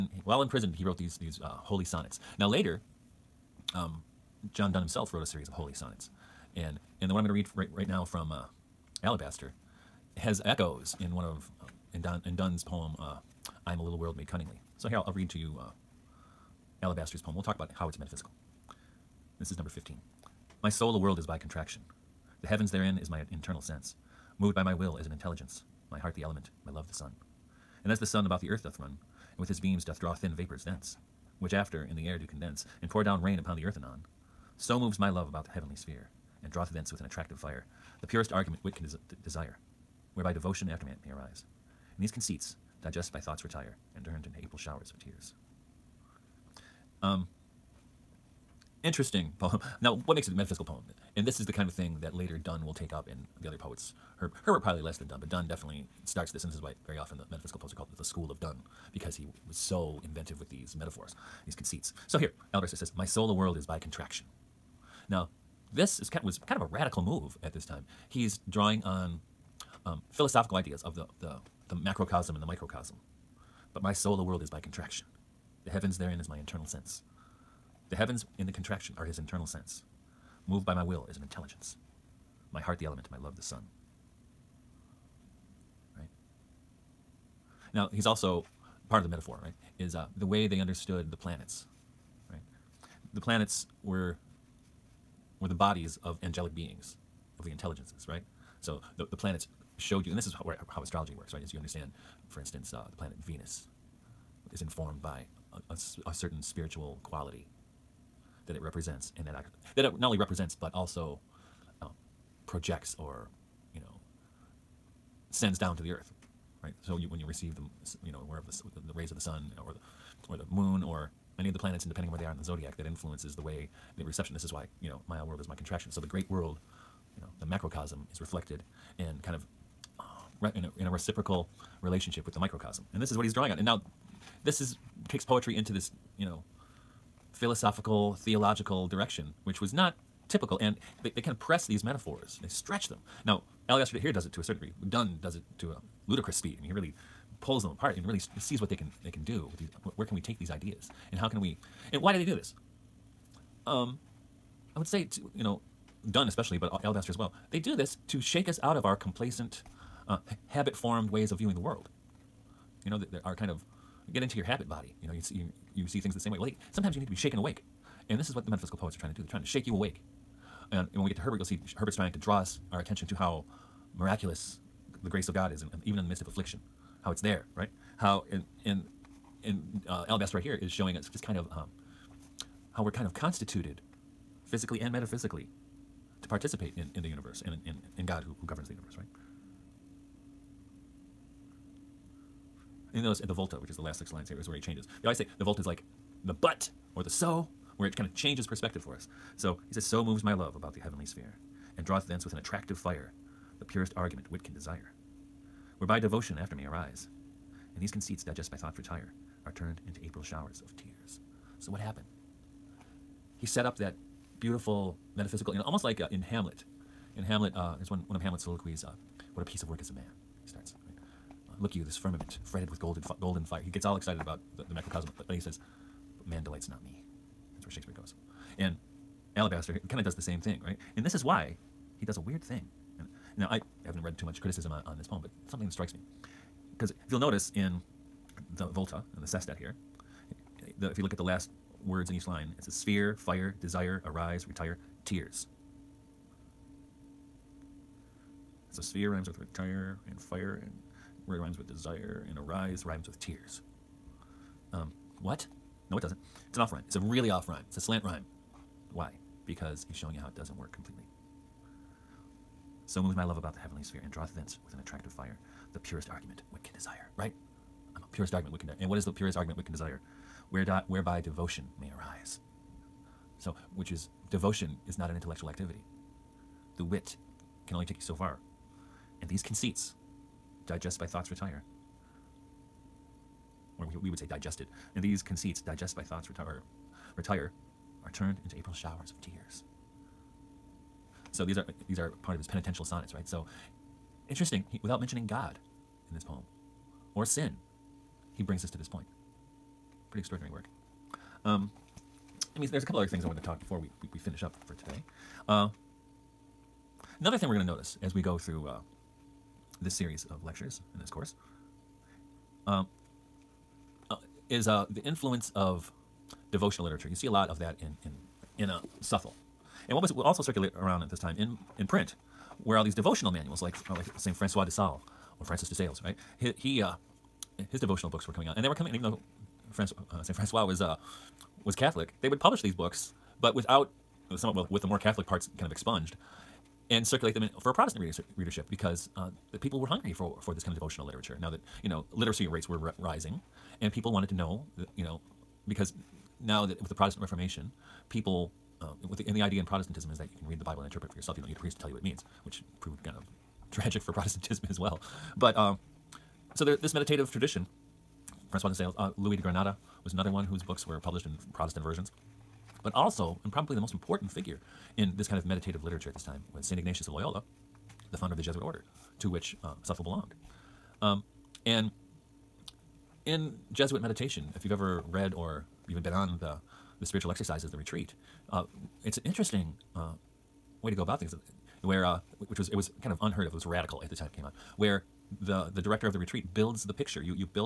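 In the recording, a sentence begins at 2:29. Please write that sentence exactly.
Where can we take these ideas, and how can we, and why do they do this?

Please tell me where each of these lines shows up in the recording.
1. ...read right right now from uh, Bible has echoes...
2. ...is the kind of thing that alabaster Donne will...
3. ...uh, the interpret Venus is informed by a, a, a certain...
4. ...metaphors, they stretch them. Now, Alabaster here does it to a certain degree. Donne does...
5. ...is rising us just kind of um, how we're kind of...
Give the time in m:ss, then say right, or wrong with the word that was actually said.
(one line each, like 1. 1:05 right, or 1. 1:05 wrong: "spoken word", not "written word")
1. 0:07 wrong: "Alabaster", not "Bible"
2. 0:51 wrong: "later", not "alabaster"
3. 1:42 wrong: "planet", not "interpret"
4. 2:21 right
5. 3:00 wrong: "showing", not "rising".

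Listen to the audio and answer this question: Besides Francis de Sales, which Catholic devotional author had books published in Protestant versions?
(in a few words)
Louis de Granada.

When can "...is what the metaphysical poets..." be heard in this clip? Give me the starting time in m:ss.
2:48.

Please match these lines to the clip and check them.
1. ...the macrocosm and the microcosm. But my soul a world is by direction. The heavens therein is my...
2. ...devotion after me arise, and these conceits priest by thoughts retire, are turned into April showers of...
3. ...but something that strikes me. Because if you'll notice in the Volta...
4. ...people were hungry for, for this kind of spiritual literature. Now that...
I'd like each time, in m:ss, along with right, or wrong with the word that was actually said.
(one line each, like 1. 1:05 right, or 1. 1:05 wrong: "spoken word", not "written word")
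1. 1:11 wrong: "contraction", not "direction"
2. 3:25 wrong: "digest", not "priest"
3. 3:55 right
4. 5:39 wrong: "devotional", not "spiritual".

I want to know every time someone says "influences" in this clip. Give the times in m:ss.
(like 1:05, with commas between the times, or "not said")
2:02, 5:15.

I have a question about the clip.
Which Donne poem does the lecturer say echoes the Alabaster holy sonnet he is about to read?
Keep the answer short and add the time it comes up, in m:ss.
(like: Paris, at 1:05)
I'm a Little World Made Cunningly, at 0:13.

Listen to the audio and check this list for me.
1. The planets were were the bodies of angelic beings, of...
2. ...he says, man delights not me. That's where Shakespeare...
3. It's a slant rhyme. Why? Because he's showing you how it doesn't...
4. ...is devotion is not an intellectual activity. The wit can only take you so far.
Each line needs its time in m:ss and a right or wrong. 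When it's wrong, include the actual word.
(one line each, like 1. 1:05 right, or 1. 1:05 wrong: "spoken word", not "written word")
1. 1:33 right
2. 3:45 right
3. 4:17 right
4. 4:33 right.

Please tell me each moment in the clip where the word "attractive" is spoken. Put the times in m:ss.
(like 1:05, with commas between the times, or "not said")
0:37, 3:22, 4:24.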